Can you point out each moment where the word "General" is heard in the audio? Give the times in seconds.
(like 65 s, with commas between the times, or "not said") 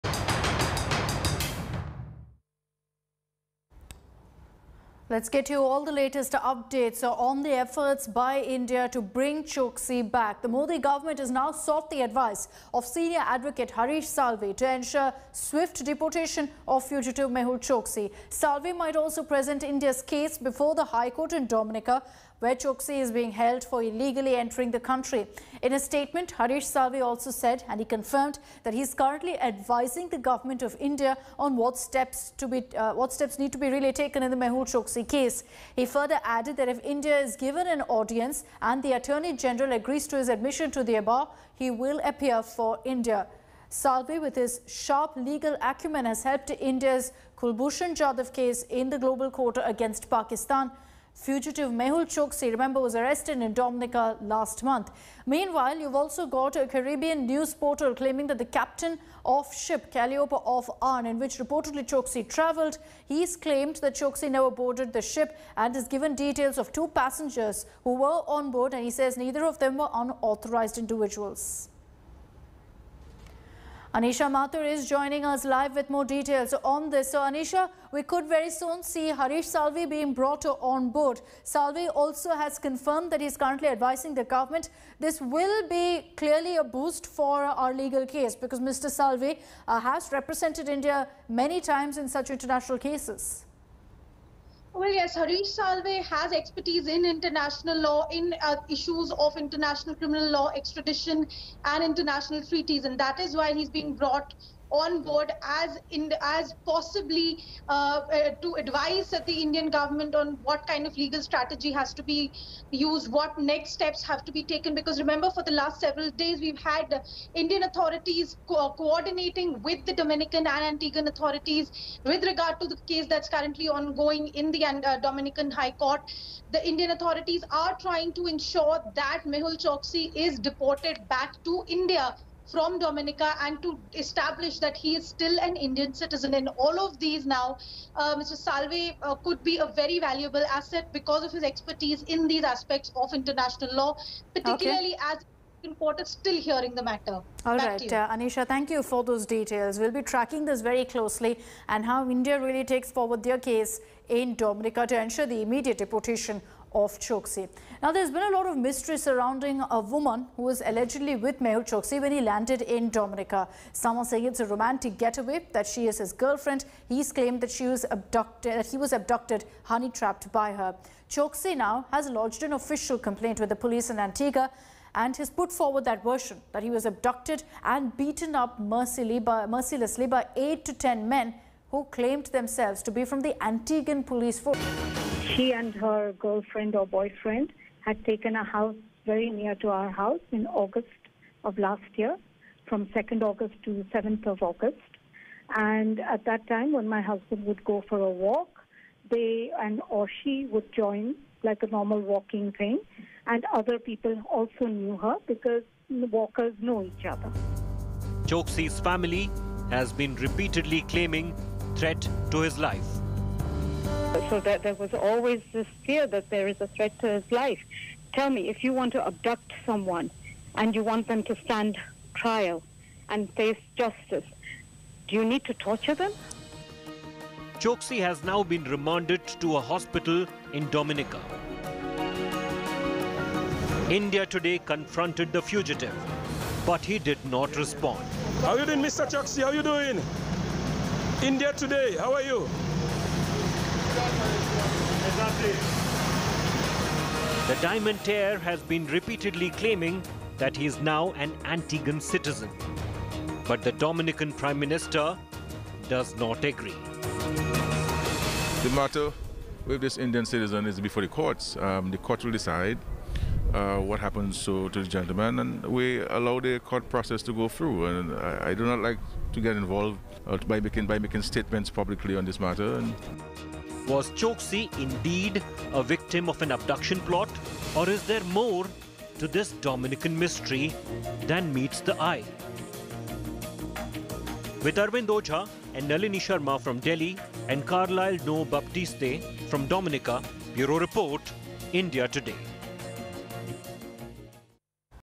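39 s.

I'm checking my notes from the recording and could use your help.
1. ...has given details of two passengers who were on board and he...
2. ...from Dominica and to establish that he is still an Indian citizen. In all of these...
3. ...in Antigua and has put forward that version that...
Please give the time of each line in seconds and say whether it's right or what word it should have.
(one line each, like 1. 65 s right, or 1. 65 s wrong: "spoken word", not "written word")
1. 65 s right
2. 132 s right
3. 173 s right.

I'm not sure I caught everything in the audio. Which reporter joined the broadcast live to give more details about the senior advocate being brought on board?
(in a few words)
Anisha Mathur.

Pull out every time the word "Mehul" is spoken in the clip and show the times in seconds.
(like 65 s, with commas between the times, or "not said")
17 s, 34 s, 51 s, 129 s, 161 s.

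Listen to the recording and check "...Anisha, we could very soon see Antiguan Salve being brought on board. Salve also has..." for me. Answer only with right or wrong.
wrong.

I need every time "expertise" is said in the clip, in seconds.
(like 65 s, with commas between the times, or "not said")
96 s, 141 s.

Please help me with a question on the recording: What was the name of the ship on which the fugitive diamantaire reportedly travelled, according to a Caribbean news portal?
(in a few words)
Calliope of Arne.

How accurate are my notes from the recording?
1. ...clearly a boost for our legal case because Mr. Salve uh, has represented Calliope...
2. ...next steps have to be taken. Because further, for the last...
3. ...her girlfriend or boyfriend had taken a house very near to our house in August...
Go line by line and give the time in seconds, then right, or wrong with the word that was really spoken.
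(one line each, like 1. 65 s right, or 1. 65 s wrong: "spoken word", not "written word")
1. 86 s wrong: "India", not "Calliope"
2. 113 s wrong: "remember", not "further"
3. 185 s right.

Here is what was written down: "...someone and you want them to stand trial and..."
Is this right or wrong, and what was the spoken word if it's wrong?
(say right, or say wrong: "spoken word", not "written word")
right.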